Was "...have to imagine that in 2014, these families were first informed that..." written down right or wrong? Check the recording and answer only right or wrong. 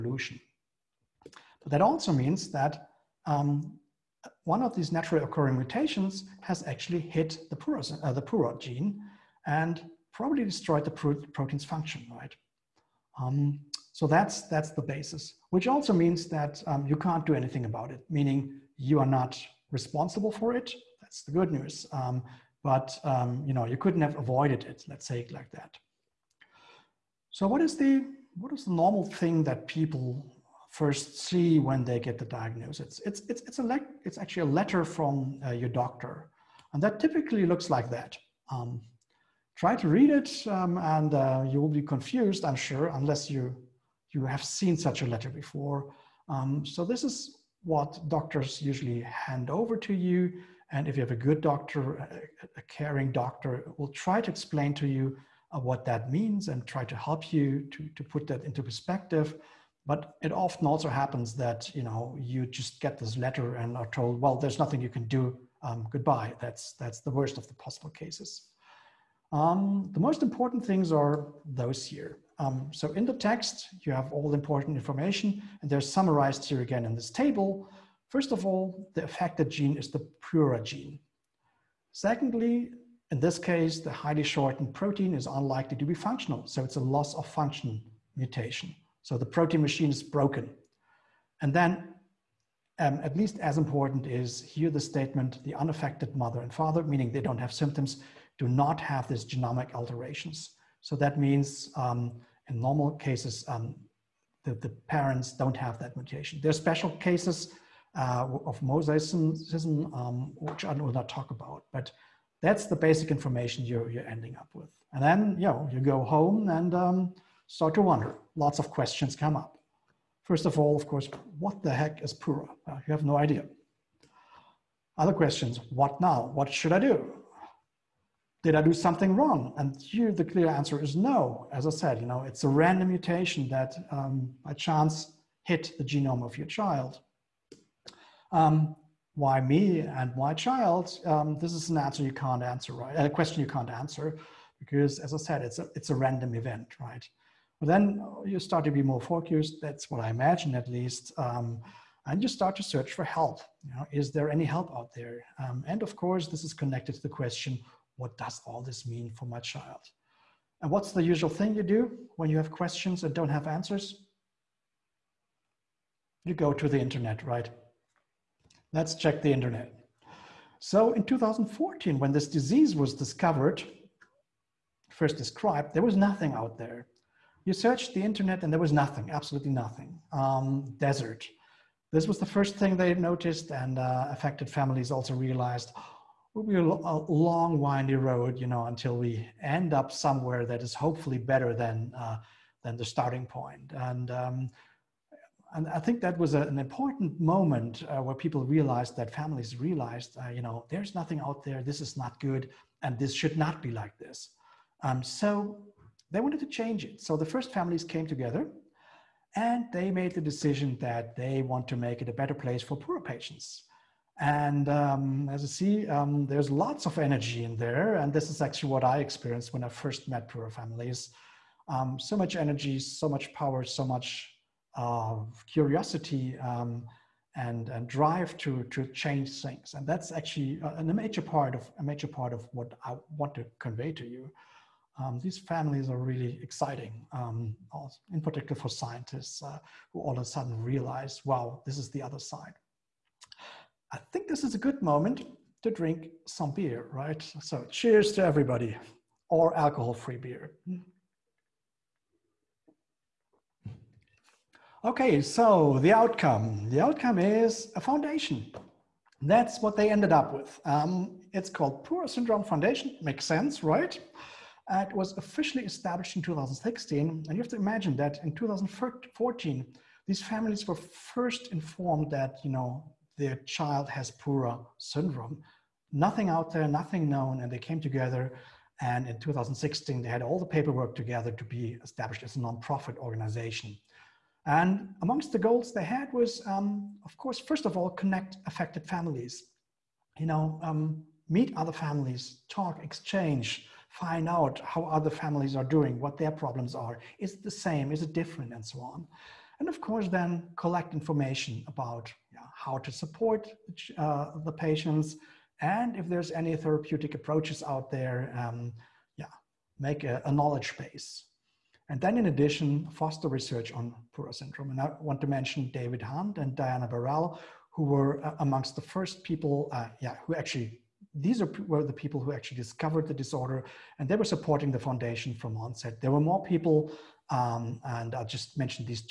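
right.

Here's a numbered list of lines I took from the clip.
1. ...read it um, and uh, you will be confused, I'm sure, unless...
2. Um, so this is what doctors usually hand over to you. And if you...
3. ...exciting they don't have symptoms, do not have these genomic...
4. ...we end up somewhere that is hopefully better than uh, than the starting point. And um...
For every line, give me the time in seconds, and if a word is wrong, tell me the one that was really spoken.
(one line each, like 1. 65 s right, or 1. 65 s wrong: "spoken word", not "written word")
1. 39 s right
2. 46 s right
3. 96 s wrong: "meaning", not "exciting"
4. 188 s right.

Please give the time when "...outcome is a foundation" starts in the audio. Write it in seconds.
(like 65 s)
256 s.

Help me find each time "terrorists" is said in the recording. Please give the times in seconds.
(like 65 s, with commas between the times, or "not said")
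not said.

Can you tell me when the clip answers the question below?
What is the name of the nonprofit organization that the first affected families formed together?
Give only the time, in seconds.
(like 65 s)
261 s.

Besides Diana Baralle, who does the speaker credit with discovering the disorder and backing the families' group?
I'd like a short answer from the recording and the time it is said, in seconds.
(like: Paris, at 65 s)
David Hunt, at 315 s.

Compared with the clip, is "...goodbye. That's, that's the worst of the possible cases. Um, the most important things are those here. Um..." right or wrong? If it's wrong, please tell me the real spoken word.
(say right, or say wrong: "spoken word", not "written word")
right.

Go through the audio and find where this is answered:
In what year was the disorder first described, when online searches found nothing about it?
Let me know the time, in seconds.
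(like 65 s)
170 s.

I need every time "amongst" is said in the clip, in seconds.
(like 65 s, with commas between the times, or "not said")
285 s, 318 s.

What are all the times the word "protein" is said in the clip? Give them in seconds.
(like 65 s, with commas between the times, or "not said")
11 s, 84 s, 89 s.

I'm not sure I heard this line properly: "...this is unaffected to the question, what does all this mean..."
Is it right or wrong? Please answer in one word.
wrong.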